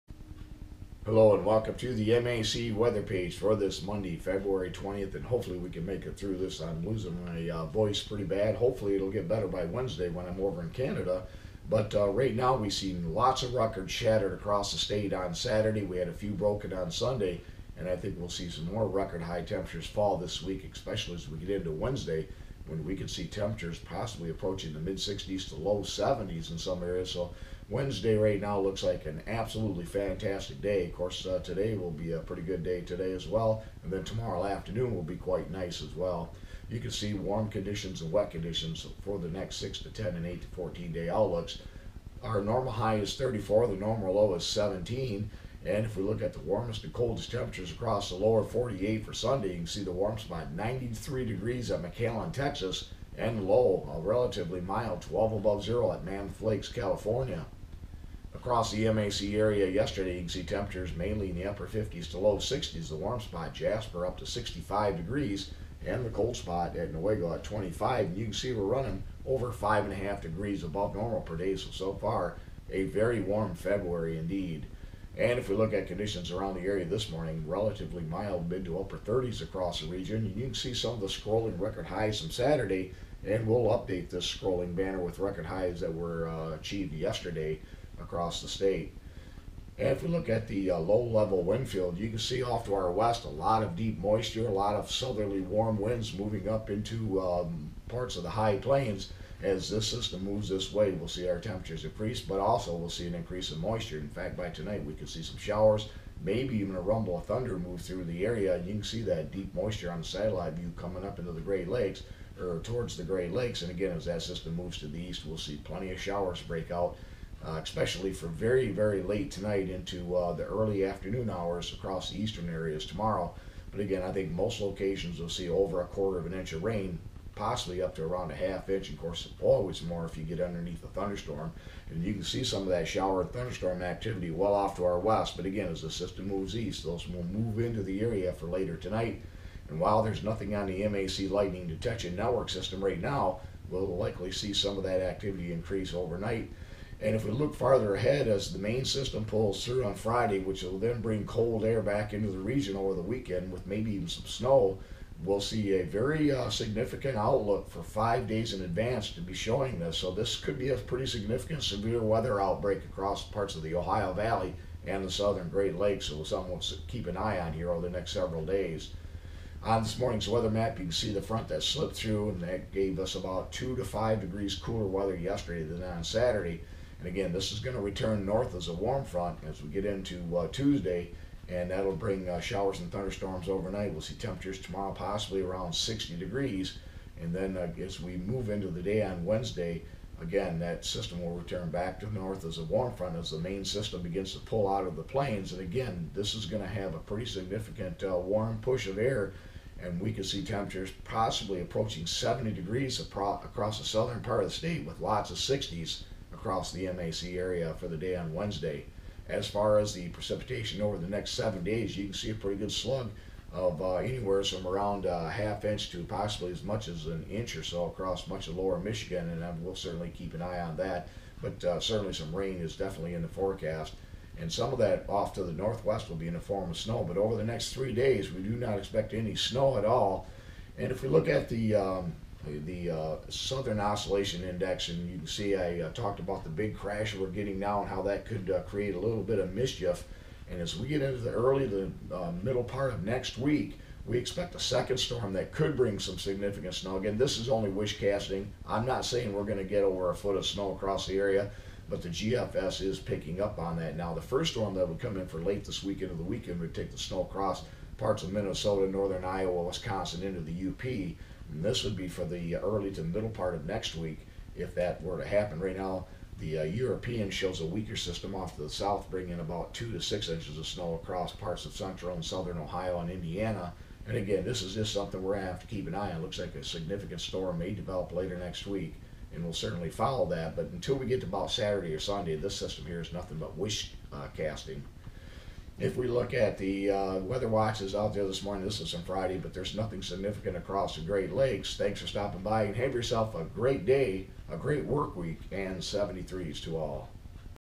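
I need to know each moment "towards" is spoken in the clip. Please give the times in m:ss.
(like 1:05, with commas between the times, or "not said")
1:52.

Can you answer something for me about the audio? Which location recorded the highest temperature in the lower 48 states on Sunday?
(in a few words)
McAllen, Texas.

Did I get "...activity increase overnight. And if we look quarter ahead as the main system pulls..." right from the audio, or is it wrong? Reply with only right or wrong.
wrong.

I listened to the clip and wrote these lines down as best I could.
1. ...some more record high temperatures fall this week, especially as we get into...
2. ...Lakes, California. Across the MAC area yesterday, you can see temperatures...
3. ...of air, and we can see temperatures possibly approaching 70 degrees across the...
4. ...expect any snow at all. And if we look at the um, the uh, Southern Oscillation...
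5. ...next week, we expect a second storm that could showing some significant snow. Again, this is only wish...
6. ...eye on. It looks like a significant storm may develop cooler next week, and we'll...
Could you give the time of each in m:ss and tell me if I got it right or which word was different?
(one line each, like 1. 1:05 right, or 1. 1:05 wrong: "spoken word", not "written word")
1. 0:18 right
2. 0:56 right
3. 3:18 right
4. 3:48 right
5. 4:03 wrong: "bring", not "showing"
6. 4:35 wrong: "later", not "cooler".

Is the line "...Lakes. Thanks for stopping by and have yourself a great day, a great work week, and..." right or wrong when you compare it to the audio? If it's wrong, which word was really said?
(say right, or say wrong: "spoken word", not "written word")
right.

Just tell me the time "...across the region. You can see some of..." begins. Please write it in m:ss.
1:19.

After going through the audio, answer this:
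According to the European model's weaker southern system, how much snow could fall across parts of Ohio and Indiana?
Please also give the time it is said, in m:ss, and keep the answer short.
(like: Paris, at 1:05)
2 to 6 inches, at 4:29.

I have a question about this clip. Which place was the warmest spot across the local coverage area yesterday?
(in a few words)
Jasper.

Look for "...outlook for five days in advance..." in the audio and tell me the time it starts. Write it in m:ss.
2:37.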